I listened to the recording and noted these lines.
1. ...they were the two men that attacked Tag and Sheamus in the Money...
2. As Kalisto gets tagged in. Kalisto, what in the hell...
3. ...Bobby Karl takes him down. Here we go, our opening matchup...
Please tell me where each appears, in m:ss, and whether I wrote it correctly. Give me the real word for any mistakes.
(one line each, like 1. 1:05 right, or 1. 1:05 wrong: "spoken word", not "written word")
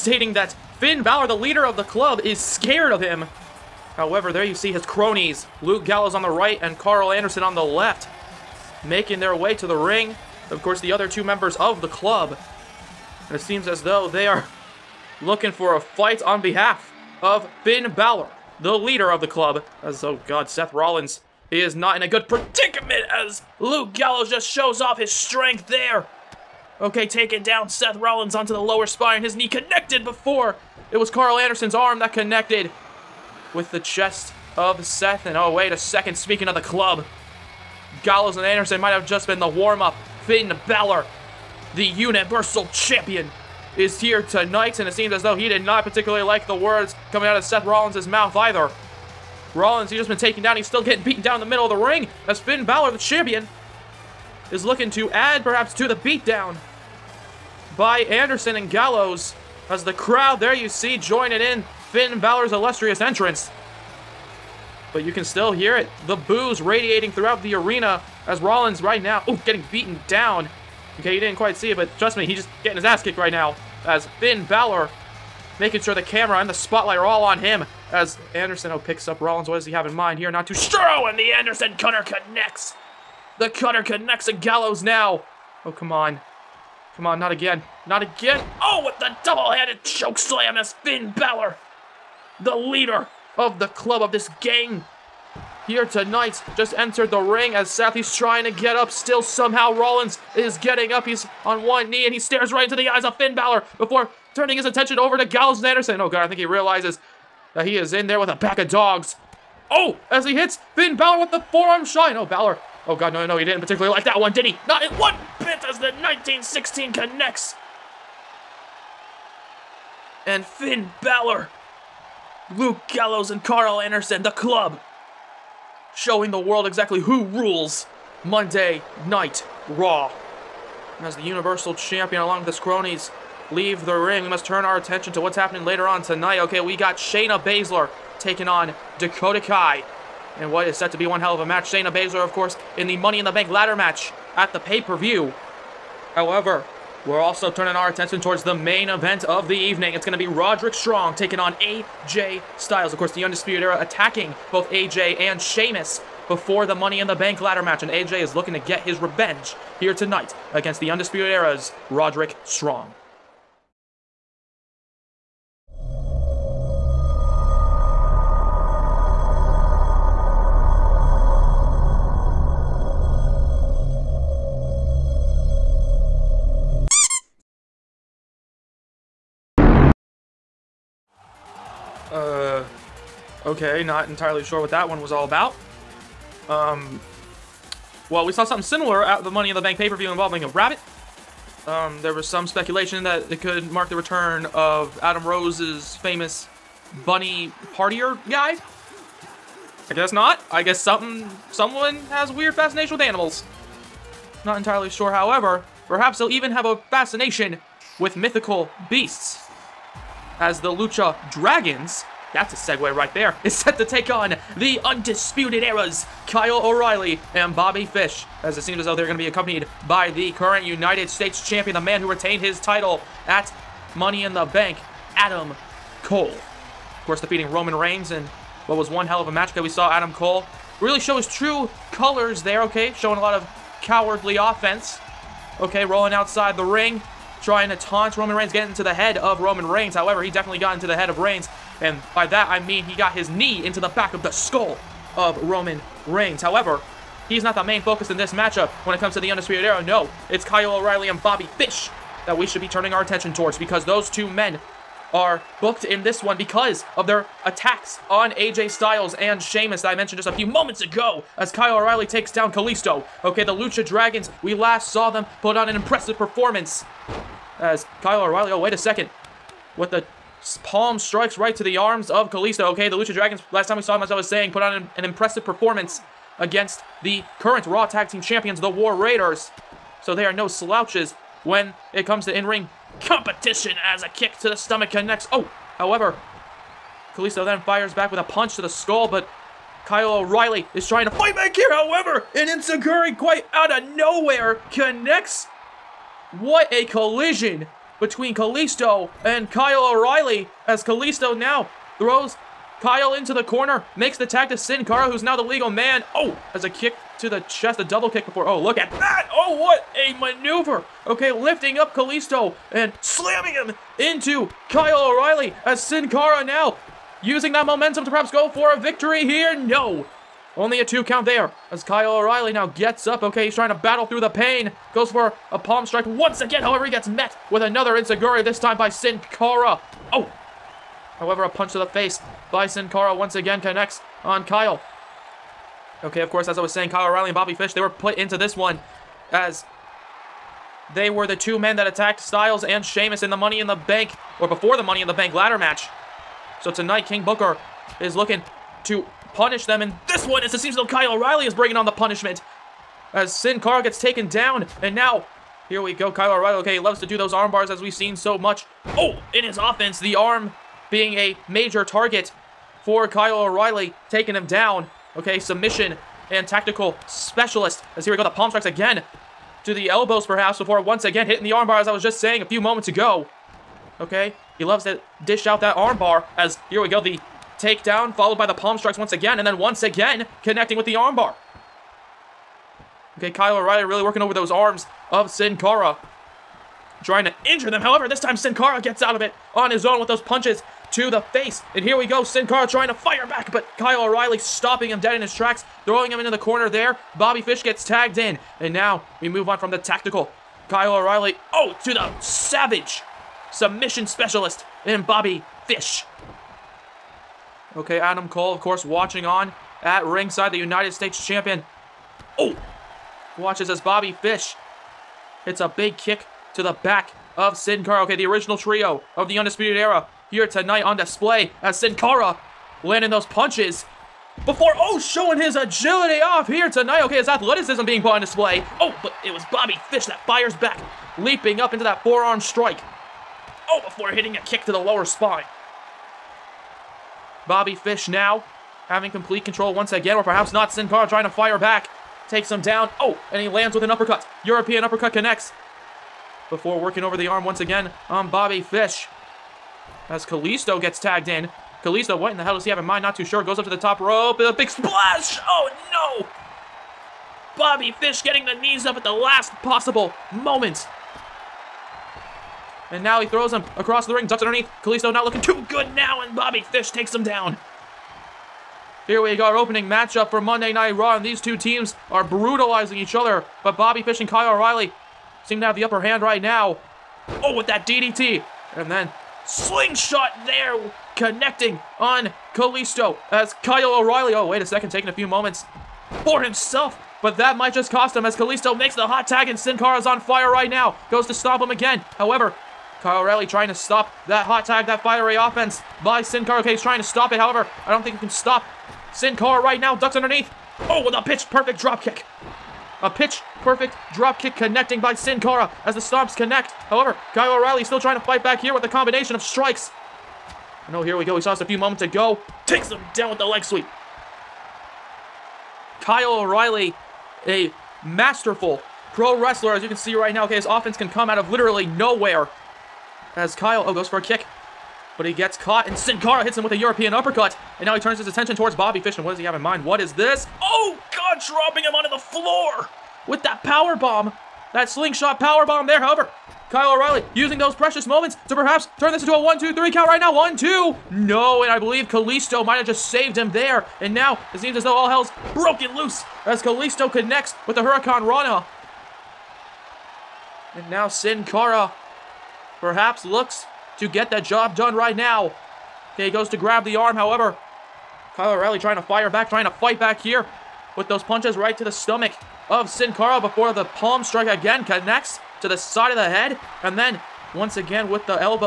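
1. 5:40 wrong: "Styles", not "Tag"
2. 7:30 right
3. 7:46 wrong: "Fish", not "Karl".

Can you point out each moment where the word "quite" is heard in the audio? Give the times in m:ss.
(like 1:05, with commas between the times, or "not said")
1:11, 4:53.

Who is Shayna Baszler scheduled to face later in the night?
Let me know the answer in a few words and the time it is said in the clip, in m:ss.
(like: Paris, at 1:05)
Dakota Kai, at 2:18.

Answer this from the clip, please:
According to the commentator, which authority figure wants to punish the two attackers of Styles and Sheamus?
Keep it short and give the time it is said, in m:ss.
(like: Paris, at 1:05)
King Booker, at 5:47.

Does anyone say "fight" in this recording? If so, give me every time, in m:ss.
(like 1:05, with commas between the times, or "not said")
0:15, 4:51, 8:28, 9:19.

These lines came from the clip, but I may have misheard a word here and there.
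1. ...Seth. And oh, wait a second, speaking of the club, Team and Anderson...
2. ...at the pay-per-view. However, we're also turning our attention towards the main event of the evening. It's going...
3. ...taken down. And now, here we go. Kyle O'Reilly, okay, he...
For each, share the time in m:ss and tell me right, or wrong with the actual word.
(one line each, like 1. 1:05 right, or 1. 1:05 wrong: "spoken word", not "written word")
1. 0:34 wrong: "Gallows", not "Team"
2. 2:24 right
3. 5:53 right.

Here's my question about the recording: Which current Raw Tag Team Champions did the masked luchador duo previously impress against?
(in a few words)
The War Raiders.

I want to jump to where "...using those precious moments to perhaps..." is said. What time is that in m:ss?
8:57.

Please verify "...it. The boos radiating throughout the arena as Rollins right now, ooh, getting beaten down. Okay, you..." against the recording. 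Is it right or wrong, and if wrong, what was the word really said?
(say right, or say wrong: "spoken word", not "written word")
right.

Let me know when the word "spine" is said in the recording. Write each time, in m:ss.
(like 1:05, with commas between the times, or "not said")
0:28, 7:15.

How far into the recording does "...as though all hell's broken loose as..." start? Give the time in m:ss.
9:04.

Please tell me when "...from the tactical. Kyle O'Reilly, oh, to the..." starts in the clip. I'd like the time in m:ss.
6:39.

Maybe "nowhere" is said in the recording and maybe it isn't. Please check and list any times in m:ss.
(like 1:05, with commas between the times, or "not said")
4:53, 8:41.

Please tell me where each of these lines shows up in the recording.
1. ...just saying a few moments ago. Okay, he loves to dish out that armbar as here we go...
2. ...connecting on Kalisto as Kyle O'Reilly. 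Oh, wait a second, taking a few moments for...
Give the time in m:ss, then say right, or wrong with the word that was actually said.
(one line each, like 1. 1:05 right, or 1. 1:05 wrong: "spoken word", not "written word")
1. 6:12 right
2. 8:01 right.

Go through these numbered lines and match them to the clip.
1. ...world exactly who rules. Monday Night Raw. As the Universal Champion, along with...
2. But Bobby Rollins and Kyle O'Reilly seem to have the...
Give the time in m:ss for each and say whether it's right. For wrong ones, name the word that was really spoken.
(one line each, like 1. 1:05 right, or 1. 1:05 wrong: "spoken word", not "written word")
1. 2:06 right
2. 7:53 wrong: "Fish", not "Rollins".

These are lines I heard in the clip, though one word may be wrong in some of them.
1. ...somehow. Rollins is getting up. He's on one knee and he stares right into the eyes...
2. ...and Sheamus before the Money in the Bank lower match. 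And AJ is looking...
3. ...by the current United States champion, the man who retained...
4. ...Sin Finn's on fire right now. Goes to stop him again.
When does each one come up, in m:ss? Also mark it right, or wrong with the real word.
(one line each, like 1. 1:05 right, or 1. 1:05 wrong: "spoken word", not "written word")
1. 1:39 right
2. 2:35 wrong: "ladder", not "lower"
3. 3:39 right
4. 8:09 wrong: "Cara", not "Finn".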